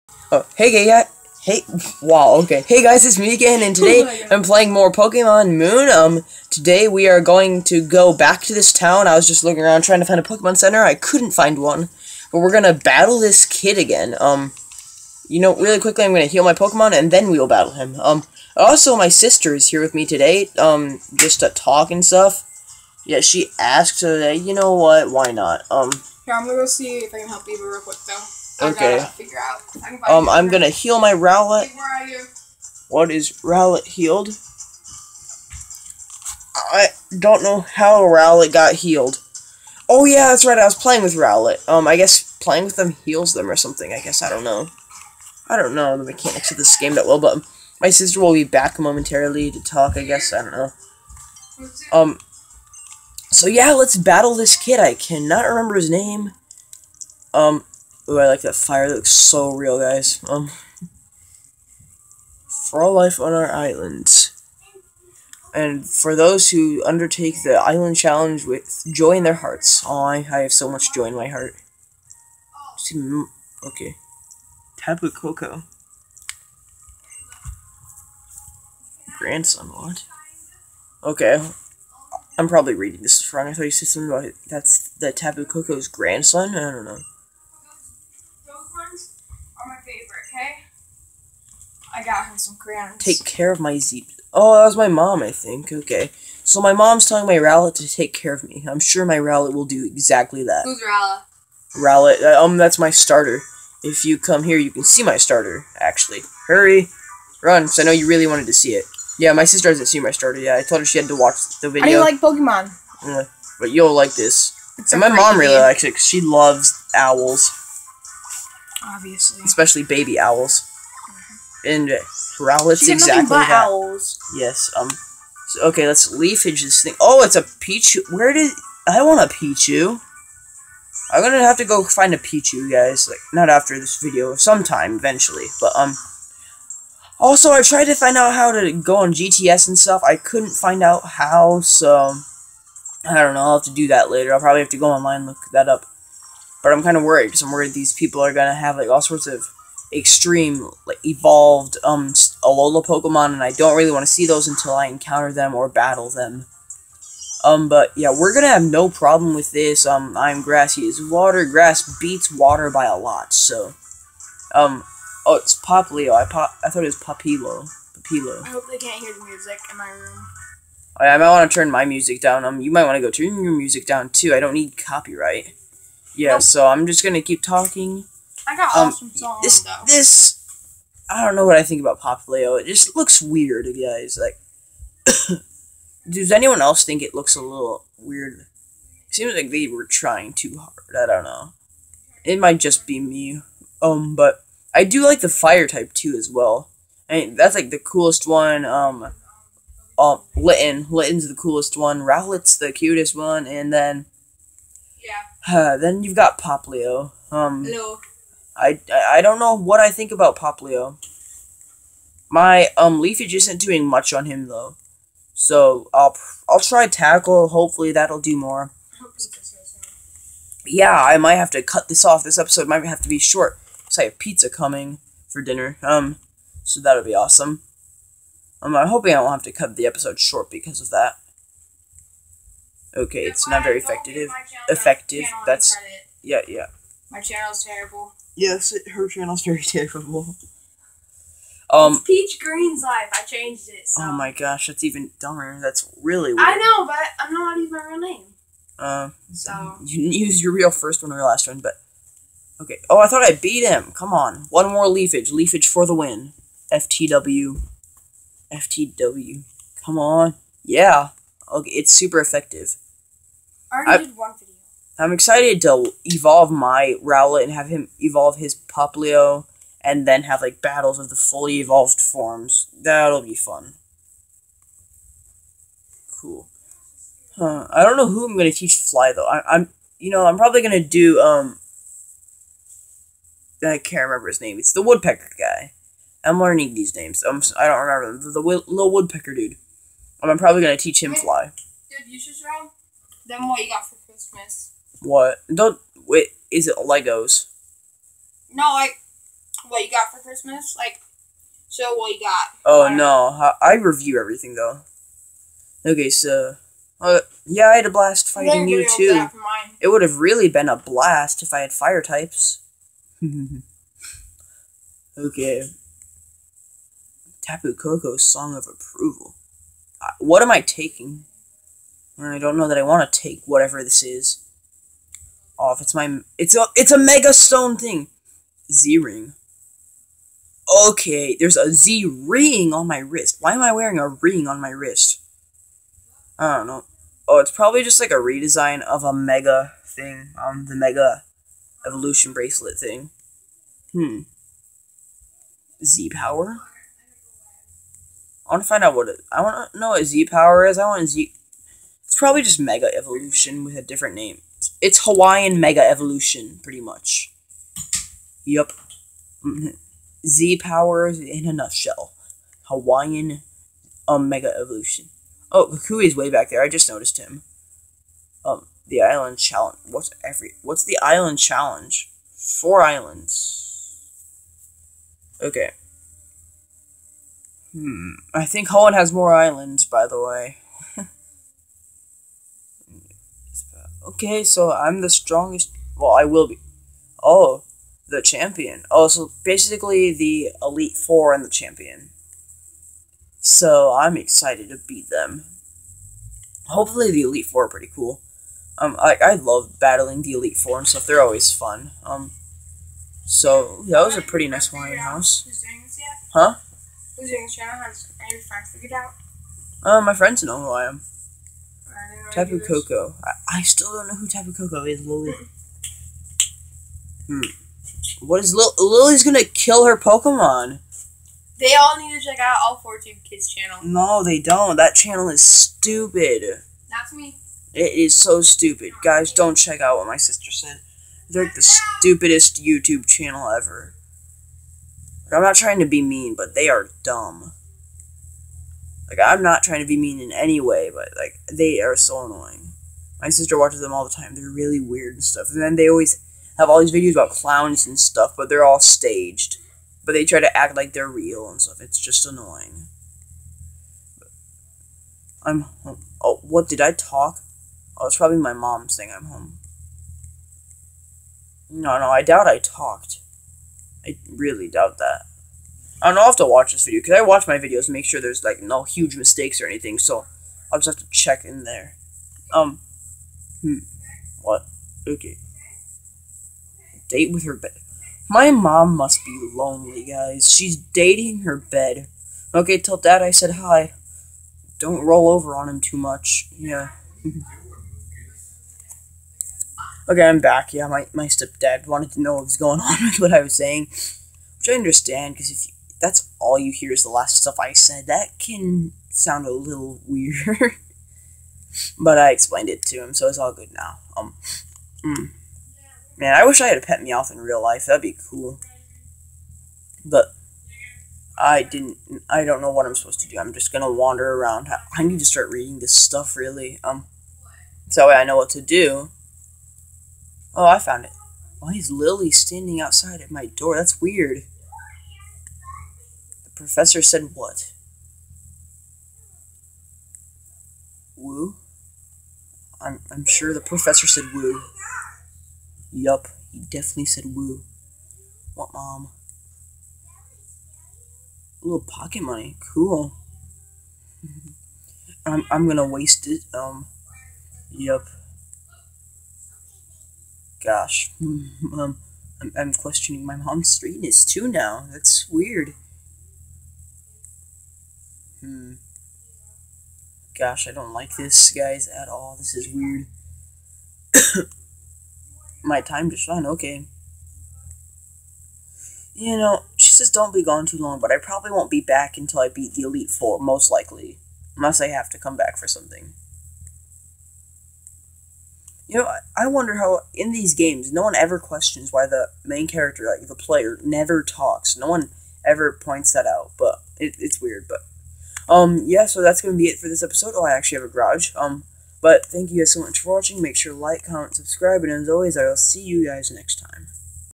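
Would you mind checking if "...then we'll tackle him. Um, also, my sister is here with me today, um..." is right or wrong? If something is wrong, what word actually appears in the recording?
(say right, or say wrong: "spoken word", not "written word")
wrong: "battle", not "tackle".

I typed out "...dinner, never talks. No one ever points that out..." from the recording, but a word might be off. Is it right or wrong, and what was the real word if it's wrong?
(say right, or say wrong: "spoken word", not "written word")
wrong: "player", not "dinner".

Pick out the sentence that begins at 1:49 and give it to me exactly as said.
Yeah, my sister hasn't seen my starter yet.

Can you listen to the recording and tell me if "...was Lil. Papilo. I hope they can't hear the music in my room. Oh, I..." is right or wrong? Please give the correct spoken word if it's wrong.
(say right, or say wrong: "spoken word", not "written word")
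wrong: "Papilo", not "Lil".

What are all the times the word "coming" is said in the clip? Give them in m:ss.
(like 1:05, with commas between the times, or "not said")
3:44.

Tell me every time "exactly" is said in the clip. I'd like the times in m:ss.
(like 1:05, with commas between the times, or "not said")
1:39, 2:02.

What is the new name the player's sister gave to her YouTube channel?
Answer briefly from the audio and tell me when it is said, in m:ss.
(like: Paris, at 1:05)
Peach Green's life, at 4:02.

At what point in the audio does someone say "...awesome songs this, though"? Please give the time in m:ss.
2:58.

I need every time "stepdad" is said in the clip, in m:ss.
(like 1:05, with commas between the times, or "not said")
8:11.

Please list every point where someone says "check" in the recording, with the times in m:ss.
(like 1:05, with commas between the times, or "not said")
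7:02, 7:09, 7:51.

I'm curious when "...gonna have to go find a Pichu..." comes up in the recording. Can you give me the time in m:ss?
2:11.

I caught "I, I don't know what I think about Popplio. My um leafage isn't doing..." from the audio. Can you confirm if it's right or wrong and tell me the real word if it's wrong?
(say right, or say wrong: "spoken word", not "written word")
right.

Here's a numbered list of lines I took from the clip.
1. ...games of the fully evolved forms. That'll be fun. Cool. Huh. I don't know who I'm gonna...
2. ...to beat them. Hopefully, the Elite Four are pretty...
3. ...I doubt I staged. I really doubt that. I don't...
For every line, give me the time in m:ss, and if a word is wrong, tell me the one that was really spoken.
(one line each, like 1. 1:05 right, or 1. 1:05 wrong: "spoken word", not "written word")
1. 4:30 wrong: "battles", not "games"
2. 6:34 right
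3. 7:42 wrong: "talked", not "staged".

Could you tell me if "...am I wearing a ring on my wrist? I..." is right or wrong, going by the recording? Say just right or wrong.
right.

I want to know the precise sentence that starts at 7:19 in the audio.
Like I'm not trying to be mean in any way, but like they are so annoying.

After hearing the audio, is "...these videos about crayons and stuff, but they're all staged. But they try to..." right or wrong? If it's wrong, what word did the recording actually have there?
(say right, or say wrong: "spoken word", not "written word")
wrong: "clowns", not "crayons".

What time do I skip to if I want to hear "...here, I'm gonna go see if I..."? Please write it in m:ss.
0:26.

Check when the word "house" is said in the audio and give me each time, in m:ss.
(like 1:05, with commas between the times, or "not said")
6:44.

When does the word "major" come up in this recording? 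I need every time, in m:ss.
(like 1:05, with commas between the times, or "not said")
not said.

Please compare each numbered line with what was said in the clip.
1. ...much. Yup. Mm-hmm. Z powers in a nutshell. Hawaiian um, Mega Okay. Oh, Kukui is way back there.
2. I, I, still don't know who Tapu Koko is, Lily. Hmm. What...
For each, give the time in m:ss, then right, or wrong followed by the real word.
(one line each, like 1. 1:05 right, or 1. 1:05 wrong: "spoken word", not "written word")
1. 5:56 wrong: "Evolution", not "Okay"
2. 6:53 right.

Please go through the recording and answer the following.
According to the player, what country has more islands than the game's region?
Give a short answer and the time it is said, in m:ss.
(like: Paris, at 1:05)
Holland, at 6:18.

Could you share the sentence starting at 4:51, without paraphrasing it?
Dude, you should show them what you got for Christmas.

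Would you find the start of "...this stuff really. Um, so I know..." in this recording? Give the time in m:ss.
8:35.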